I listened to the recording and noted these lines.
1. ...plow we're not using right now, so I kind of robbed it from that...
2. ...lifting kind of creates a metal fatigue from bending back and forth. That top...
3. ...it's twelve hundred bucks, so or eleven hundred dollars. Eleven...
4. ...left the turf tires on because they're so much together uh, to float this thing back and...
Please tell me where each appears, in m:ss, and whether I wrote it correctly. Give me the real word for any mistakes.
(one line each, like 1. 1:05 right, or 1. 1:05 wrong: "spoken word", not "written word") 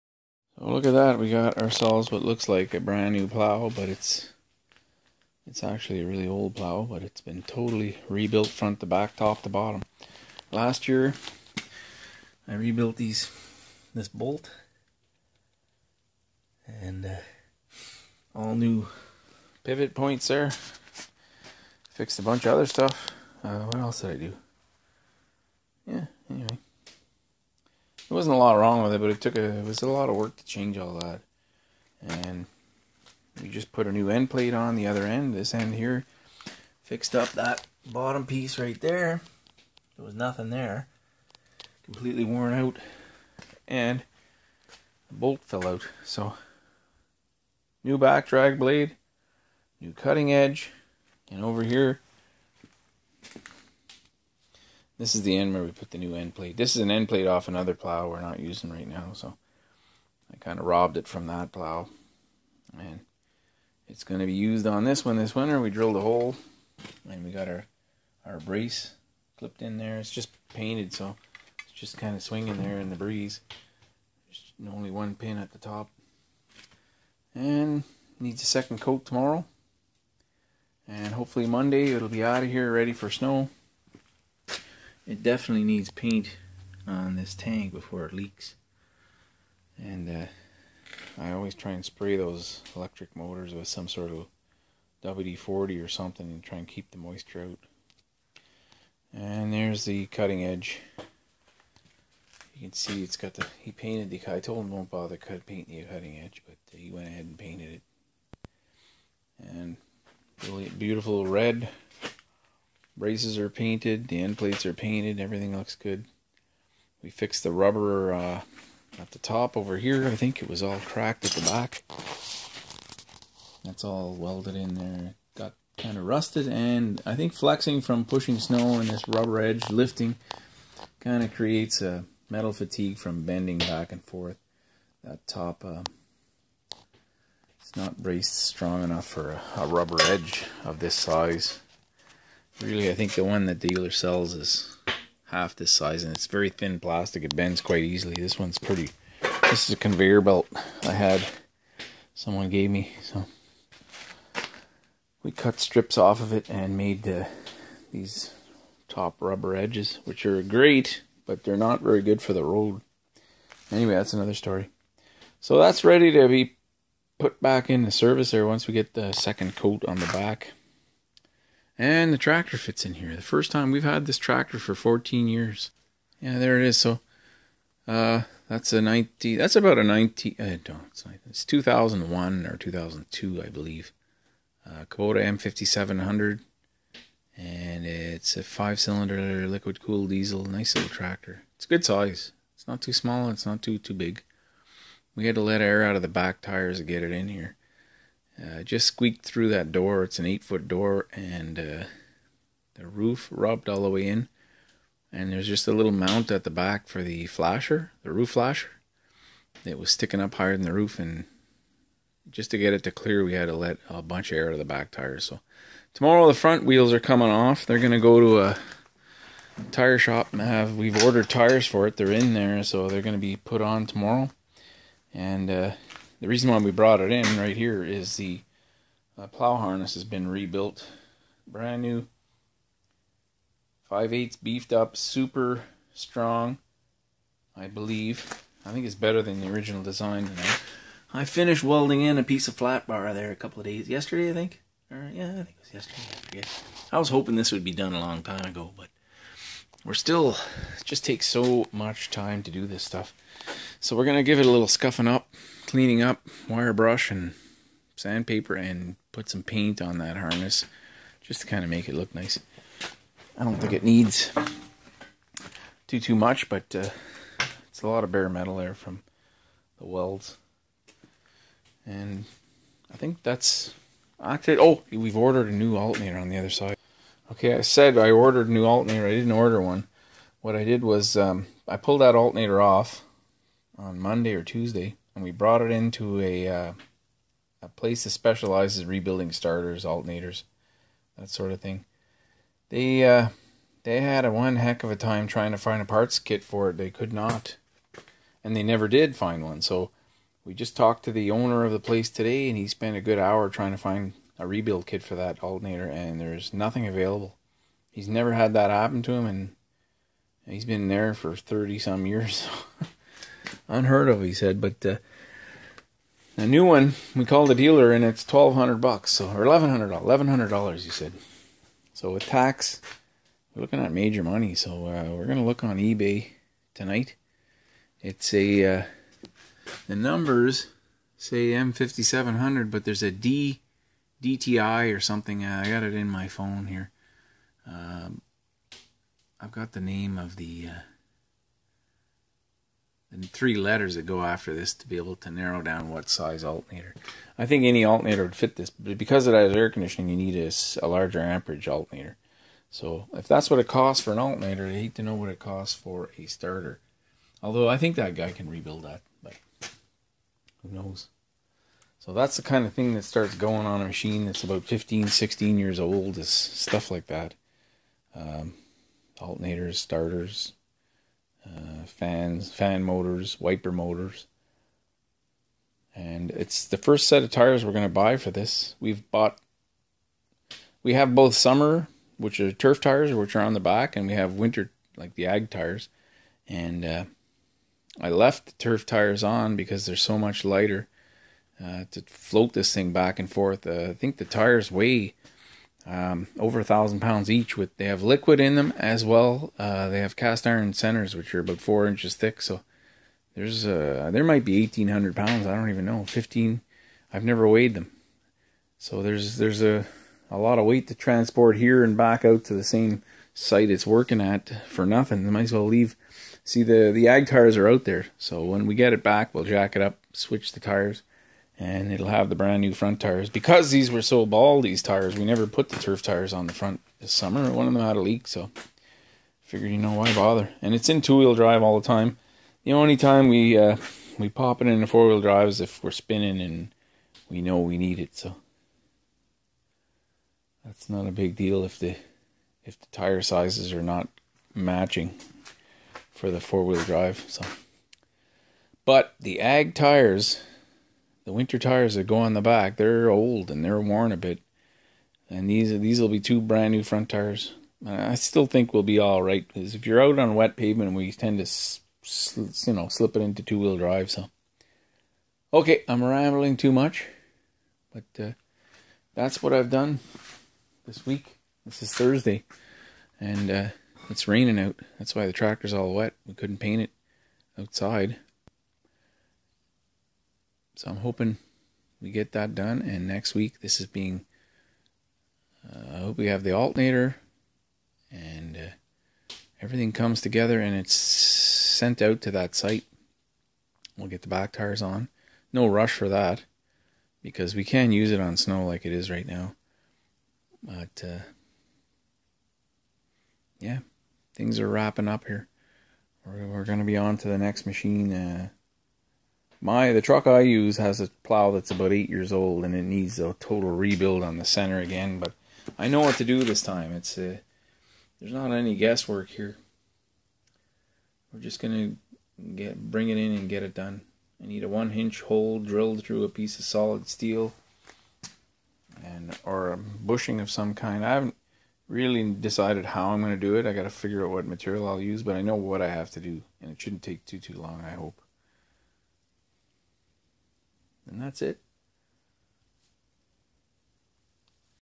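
1. 0:57 right
2. 2:09 right
3. 5:18 right
4. 6:28 wrong: "lighter", not "together".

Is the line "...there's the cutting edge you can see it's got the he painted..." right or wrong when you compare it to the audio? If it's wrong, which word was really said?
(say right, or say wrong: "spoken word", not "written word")
right.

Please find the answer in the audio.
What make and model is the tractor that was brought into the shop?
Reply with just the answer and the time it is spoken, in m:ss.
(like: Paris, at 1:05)
Kubota M5700, at 3:04.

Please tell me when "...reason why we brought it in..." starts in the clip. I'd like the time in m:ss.
3:46.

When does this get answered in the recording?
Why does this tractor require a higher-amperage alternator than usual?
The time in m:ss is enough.
5:49.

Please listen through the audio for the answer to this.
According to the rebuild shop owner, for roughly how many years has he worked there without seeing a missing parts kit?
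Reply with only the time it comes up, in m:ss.
5:11.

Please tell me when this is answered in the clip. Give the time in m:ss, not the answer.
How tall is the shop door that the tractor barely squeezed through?
3:20.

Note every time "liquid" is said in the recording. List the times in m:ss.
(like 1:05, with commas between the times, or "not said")
3:09, 6:38.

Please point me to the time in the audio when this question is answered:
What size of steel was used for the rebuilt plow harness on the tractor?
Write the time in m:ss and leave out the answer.
3:53.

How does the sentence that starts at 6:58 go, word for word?
So when we get it back, we'll jack it up, switch the tires and it'll have the brand new front tires.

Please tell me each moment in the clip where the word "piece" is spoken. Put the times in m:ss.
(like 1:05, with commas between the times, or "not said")
0:38, 4:02, 8:46.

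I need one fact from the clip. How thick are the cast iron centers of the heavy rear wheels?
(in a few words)
4 inches.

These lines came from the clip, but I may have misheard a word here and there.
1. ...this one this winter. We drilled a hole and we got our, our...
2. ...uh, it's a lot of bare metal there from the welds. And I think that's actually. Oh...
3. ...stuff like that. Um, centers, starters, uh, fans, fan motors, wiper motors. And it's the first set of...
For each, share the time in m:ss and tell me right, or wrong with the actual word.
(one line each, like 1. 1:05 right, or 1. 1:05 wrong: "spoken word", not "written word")
1. 1:04 right
2. 4:26 right
3. 6:06 wrong: "alternators", not "centers".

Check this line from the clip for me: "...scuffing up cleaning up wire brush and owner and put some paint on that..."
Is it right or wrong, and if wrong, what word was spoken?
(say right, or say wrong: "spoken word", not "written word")
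wrong: "sandpaper", not "owner".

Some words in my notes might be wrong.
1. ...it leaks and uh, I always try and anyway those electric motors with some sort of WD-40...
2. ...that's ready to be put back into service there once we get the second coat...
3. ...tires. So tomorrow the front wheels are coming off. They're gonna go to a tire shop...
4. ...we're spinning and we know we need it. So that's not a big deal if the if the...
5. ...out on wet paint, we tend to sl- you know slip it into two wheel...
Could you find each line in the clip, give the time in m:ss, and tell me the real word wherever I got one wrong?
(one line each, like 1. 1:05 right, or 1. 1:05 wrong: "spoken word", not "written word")
1. 1:28 wrong: "spray", not "anyway"
2. 2:45 right
3. 3:34 right
4. 7:15 right
5. 7:40 wrong: "pavement", not "paint".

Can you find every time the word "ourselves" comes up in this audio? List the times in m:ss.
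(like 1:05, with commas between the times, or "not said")
0:01.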